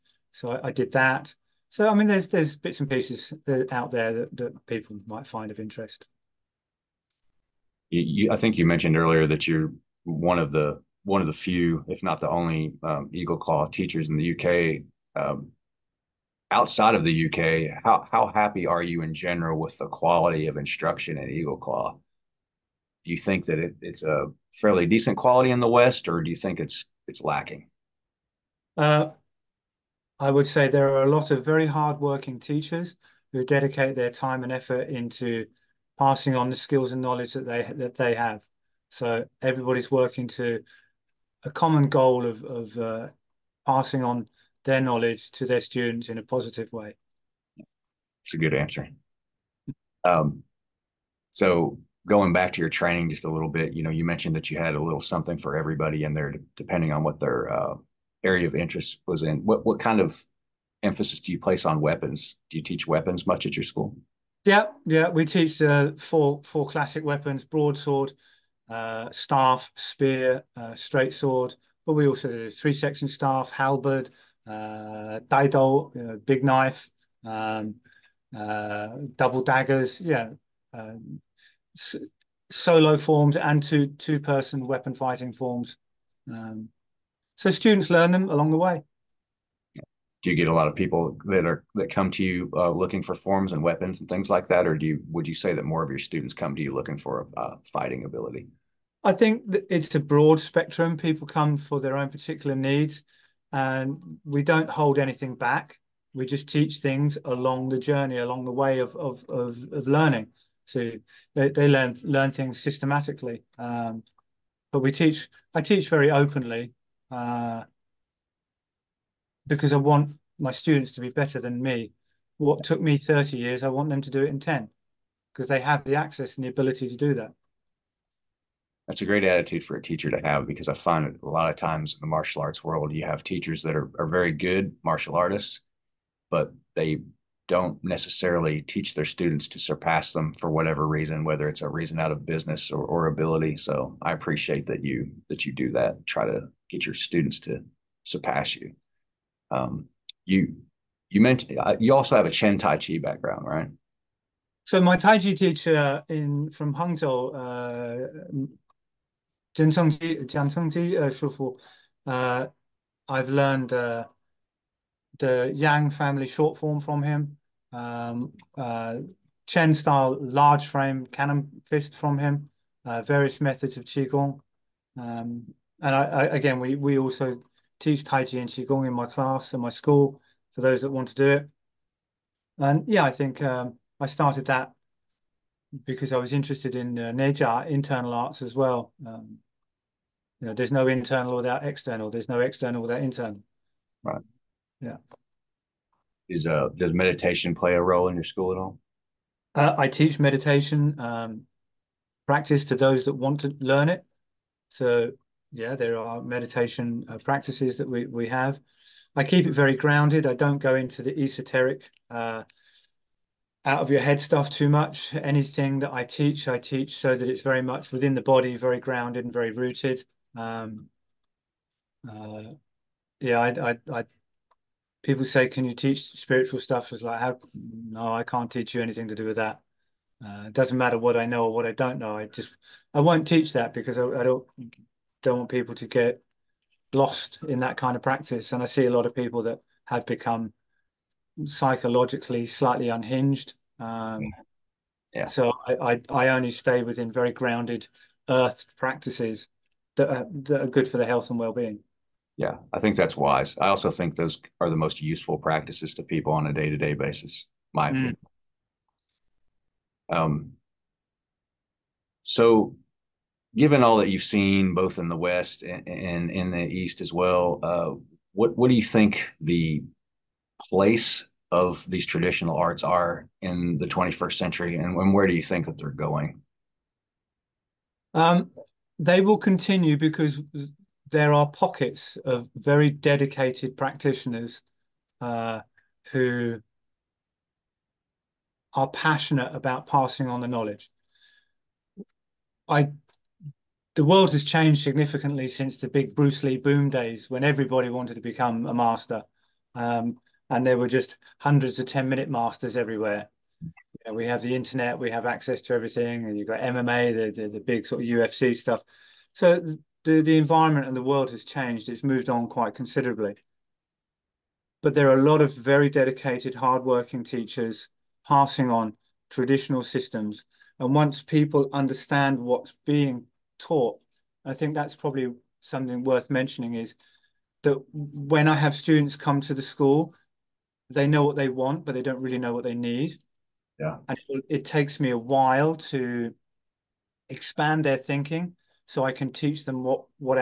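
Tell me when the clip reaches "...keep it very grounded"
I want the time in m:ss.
3:29.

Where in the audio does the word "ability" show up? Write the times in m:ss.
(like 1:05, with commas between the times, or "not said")
1:38, 2:06, 2:23.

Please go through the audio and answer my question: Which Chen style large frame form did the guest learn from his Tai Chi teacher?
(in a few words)
Cannon fist.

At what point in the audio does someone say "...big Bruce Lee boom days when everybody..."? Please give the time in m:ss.
4:55.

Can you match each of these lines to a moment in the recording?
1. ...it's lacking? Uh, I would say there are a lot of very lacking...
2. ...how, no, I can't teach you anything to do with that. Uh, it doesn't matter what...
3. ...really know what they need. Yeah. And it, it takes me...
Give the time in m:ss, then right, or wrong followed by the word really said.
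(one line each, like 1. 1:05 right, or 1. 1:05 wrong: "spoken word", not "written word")
1. 0:27 wrong: "hardworking", not "lacking"
2. 3:47 right
3. 5:32 right.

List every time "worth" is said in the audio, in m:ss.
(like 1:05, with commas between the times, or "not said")
5:26.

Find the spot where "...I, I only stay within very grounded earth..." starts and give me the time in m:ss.
4:05.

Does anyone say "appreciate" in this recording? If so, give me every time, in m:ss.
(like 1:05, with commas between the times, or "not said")
2:24.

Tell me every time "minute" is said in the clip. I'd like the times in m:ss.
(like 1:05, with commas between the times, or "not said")
5:02.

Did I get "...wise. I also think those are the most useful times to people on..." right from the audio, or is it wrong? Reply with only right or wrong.
wrong.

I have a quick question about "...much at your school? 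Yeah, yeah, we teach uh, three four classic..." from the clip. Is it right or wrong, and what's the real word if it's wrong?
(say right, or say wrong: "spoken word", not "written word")
wrong: "four", not "three".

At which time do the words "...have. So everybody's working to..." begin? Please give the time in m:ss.
0:38.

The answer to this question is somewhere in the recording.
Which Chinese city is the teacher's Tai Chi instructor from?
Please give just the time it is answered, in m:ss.
2:36.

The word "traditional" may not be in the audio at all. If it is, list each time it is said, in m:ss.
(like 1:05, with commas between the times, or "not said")
4:32, 5:19.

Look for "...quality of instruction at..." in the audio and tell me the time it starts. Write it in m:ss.
0:19.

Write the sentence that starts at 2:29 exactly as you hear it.
Um, you you mentioned uh, you also have a Chen Tai Chi background, right?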